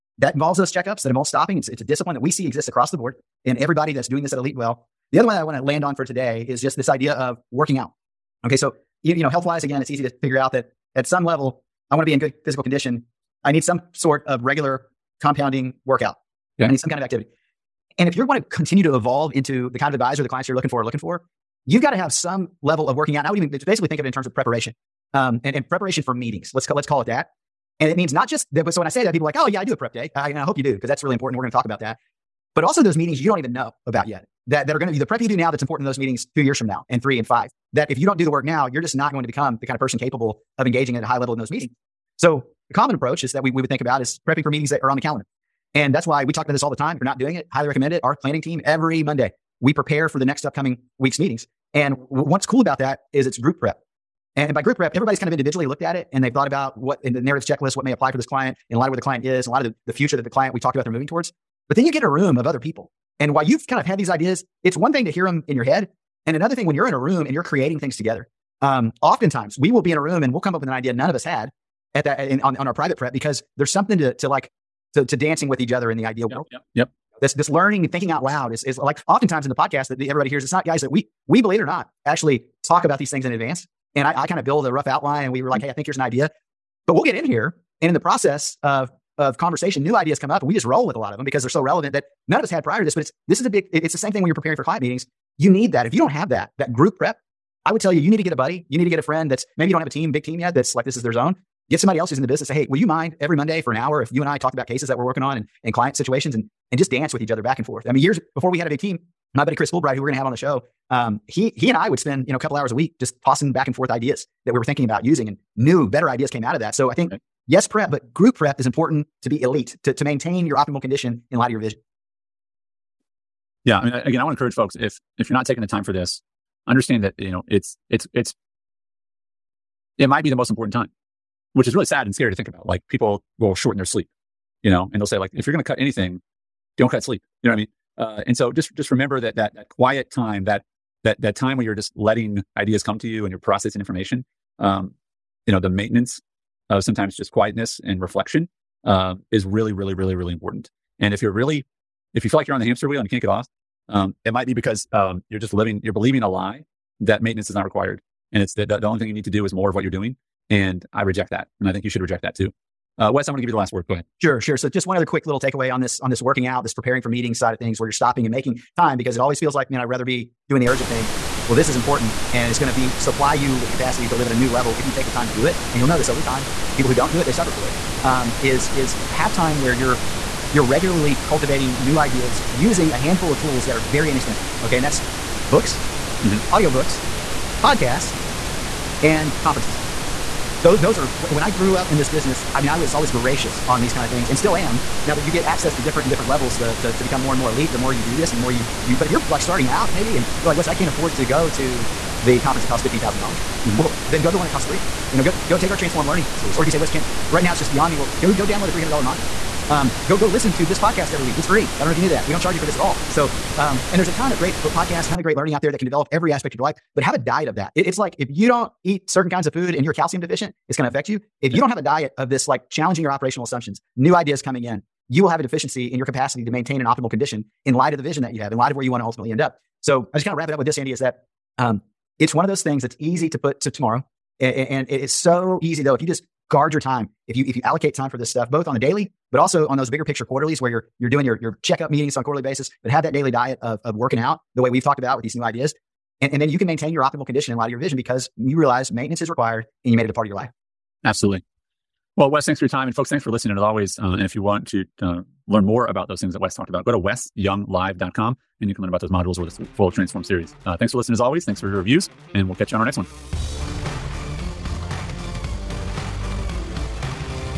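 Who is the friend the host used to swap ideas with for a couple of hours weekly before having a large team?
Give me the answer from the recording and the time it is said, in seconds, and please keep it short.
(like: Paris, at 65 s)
Chris Fulbright, at 109 s.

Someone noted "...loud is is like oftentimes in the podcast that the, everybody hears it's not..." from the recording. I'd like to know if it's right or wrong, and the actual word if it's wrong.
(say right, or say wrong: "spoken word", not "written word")
right.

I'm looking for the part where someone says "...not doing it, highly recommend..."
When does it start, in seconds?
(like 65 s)
47 s.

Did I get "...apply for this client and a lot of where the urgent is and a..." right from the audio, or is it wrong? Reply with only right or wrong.
wrong.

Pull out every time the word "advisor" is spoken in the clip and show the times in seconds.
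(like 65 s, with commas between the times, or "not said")
19 s.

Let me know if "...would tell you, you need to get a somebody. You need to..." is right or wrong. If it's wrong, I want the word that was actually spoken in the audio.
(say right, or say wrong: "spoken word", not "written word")
wrong: "buddy", not "somebody".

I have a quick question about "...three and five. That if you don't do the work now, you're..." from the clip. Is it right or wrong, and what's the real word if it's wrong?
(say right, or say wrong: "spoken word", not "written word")
right.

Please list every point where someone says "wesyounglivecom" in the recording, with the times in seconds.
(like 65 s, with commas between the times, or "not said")
256 s.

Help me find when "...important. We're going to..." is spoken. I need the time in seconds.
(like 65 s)
31 s.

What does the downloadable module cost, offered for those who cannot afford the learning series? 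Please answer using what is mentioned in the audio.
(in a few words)
$300.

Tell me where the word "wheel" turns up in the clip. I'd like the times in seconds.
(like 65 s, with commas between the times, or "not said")
152 s.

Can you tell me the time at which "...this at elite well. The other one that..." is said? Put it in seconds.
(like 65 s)
4 s.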